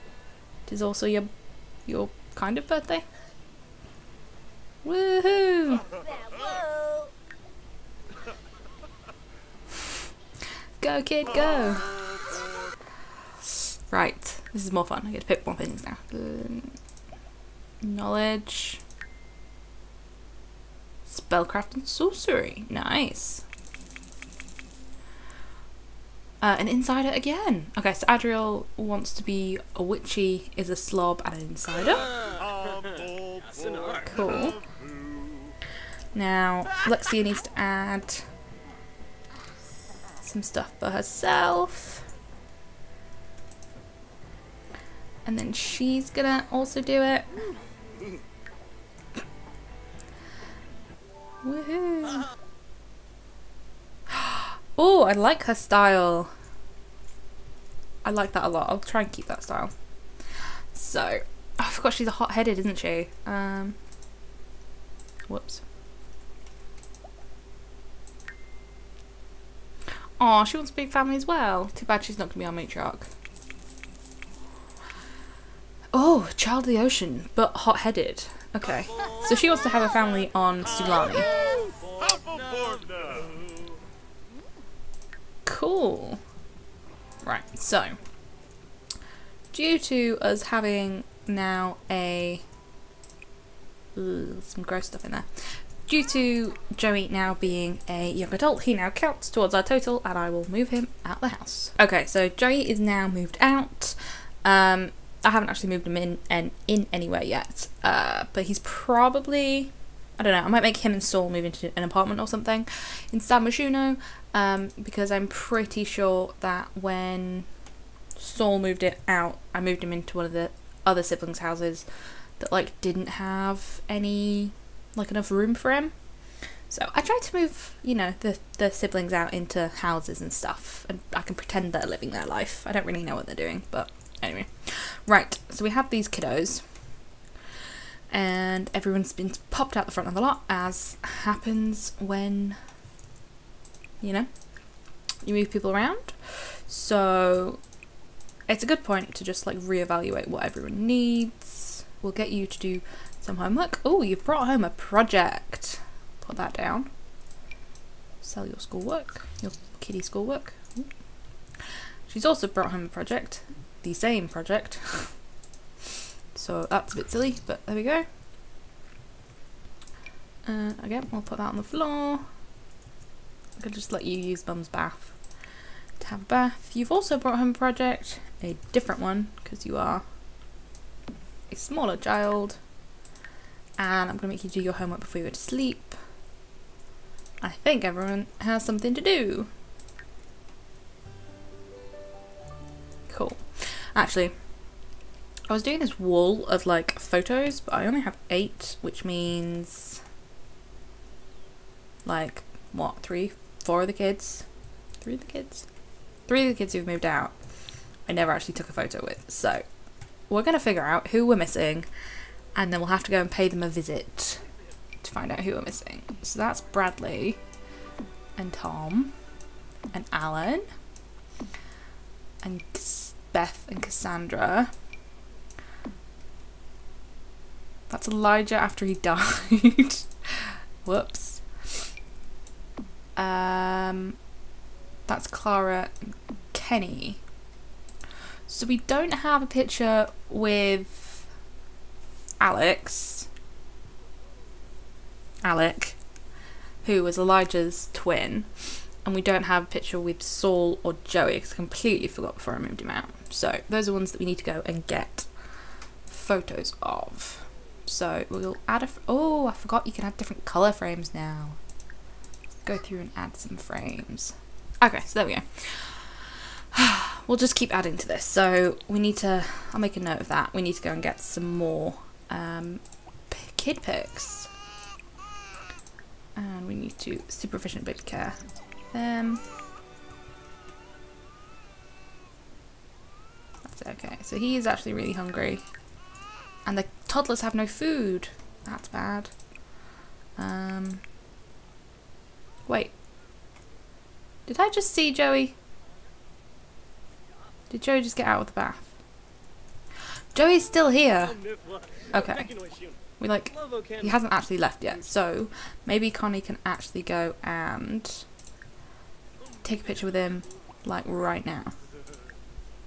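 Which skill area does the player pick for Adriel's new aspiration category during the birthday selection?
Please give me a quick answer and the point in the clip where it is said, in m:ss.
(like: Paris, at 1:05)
Spellcraft and sorcery, at 0:21.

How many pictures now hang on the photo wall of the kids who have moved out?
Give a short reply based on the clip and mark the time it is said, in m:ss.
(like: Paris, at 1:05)
8, at 3:18.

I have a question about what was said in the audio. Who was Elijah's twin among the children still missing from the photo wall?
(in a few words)
Alec.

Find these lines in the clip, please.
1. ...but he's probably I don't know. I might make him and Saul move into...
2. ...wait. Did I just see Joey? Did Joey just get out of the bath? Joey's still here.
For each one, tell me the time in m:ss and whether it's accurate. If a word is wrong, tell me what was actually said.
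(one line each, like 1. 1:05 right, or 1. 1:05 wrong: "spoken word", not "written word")
1. 1:48 right
2. 4:52 right.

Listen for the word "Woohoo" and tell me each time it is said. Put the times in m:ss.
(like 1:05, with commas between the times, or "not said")
0:04, 0:51.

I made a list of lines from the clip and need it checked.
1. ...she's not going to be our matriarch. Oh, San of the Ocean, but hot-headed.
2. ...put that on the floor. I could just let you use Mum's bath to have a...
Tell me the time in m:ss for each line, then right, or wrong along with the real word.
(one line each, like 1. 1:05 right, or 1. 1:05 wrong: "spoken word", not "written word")
1. 1:12 wrong: "Child", not "San"
2. 2:51 right.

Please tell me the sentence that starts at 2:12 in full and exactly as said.
I don't really know what they're doing, but anyway.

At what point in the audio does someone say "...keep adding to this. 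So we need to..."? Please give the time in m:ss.
4:27.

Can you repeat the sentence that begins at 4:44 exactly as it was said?
So he is actually really hungry.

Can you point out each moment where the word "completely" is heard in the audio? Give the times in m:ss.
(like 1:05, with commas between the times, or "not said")
4:11.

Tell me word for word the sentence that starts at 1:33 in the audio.
Ooh, some gross stuff in there.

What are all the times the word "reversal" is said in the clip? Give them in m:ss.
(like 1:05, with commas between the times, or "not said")
not said.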